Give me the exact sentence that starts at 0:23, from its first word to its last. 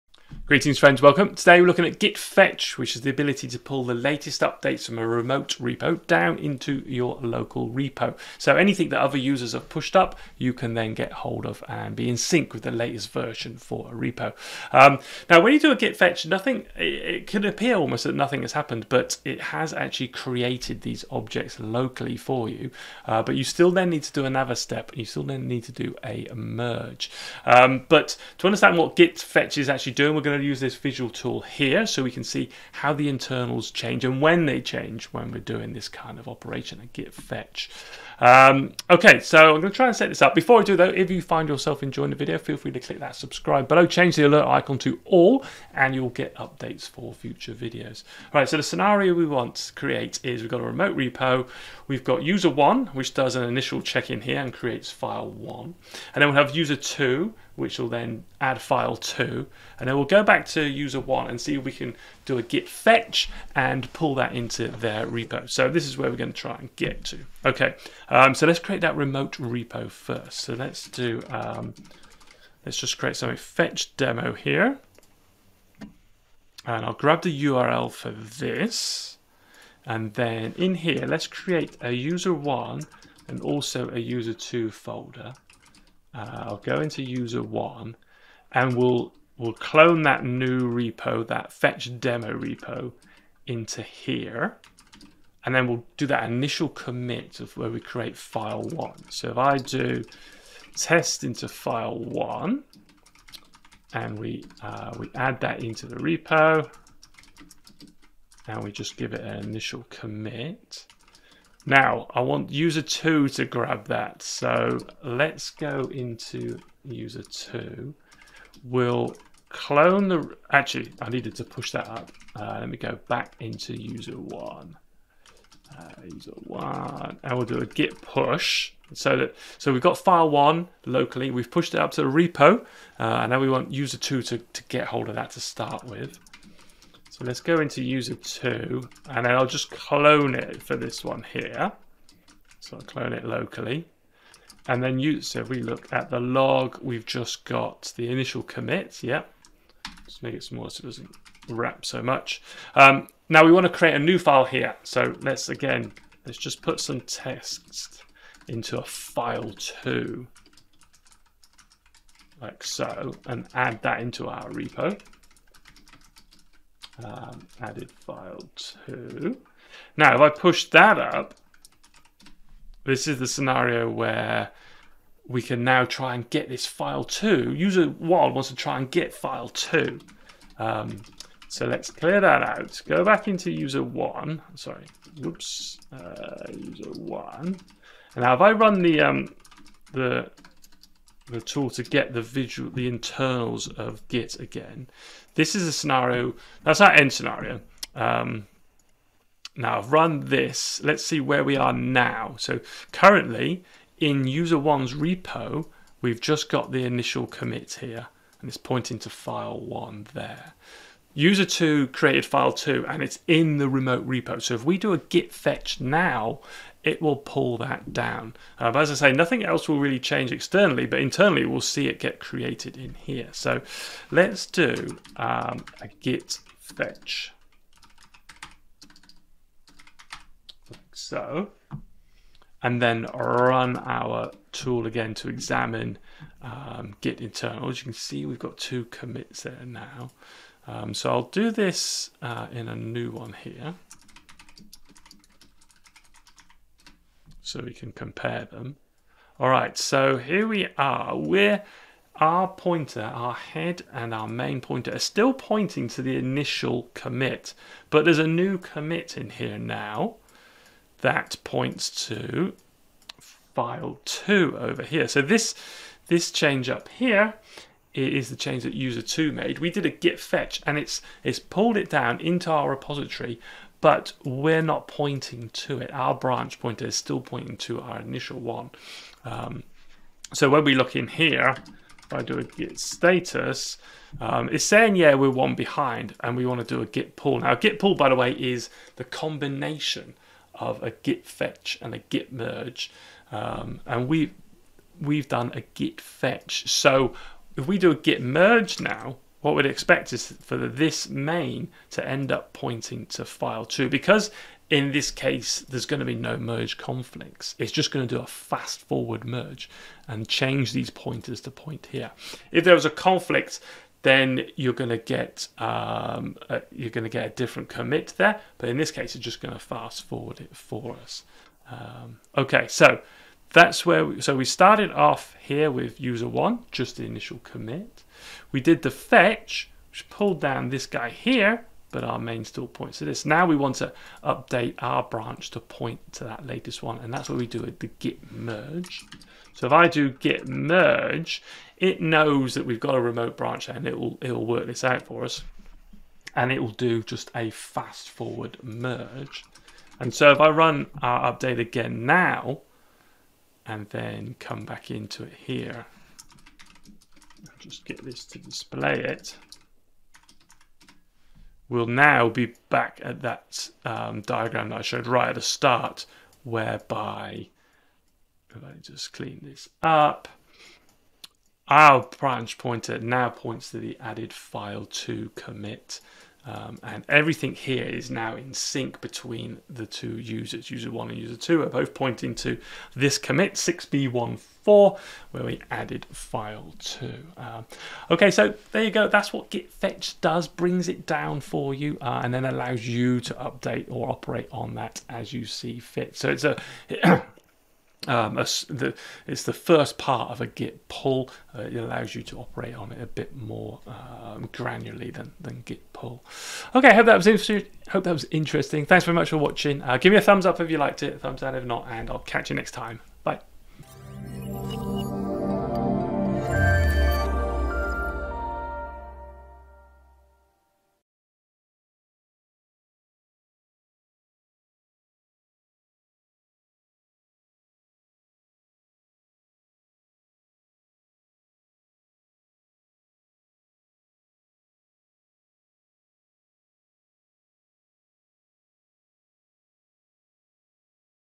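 Uh, but you still then need to do another step.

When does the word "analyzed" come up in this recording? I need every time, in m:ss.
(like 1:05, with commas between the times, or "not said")
not said.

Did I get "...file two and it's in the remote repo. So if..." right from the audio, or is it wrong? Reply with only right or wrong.
right.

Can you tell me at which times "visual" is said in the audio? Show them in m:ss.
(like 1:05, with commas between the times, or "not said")
0:30, 3:12.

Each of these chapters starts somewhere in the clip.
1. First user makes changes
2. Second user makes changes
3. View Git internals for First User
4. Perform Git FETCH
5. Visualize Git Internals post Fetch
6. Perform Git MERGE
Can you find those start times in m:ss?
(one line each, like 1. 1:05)
1. 0:30
2. 2:00
3. 3:00
4. 3:40
5. 4:00
6. 5:40.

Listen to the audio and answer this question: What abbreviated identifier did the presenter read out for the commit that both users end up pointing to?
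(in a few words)
6b14.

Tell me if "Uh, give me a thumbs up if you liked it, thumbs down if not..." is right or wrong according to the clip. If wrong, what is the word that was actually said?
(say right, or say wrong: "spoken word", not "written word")
right.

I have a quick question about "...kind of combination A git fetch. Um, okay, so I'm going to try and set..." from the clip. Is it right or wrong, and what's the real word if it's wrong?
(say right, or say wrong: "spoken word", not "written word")
wrong: "operation", not "combination".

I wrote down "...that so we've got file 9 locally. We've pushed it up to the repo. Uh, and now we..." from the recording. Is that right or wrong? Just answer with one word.
wrong.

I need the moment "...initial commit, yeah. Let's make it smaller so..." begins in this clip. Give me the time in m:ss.
2:28.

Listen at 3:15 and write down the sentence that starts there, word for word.
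This is a scenario, that's our end scenario.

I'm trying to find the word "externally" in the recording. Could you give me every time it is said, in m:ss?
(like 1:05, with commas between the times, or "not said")
3:40.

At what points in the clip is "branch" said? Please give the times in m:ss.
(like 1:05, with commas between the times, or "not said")
4:36, 5:35, 5:43, 6:12.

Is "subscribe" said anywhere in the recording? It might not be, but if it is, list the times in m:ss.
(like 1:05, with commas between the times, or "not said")
0:43.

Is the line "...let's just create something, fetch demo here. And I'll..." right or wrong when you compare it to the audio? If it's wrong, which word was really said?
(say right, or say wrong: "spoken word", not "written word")
right.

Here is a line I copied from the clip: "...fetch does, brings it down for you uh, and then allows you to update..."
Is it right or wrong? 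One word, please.
right.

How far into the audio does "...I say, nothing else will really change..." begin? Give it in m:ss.
3:38.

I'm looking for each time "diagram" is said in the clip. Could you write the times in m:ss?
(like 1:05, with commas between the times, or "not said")
6:04.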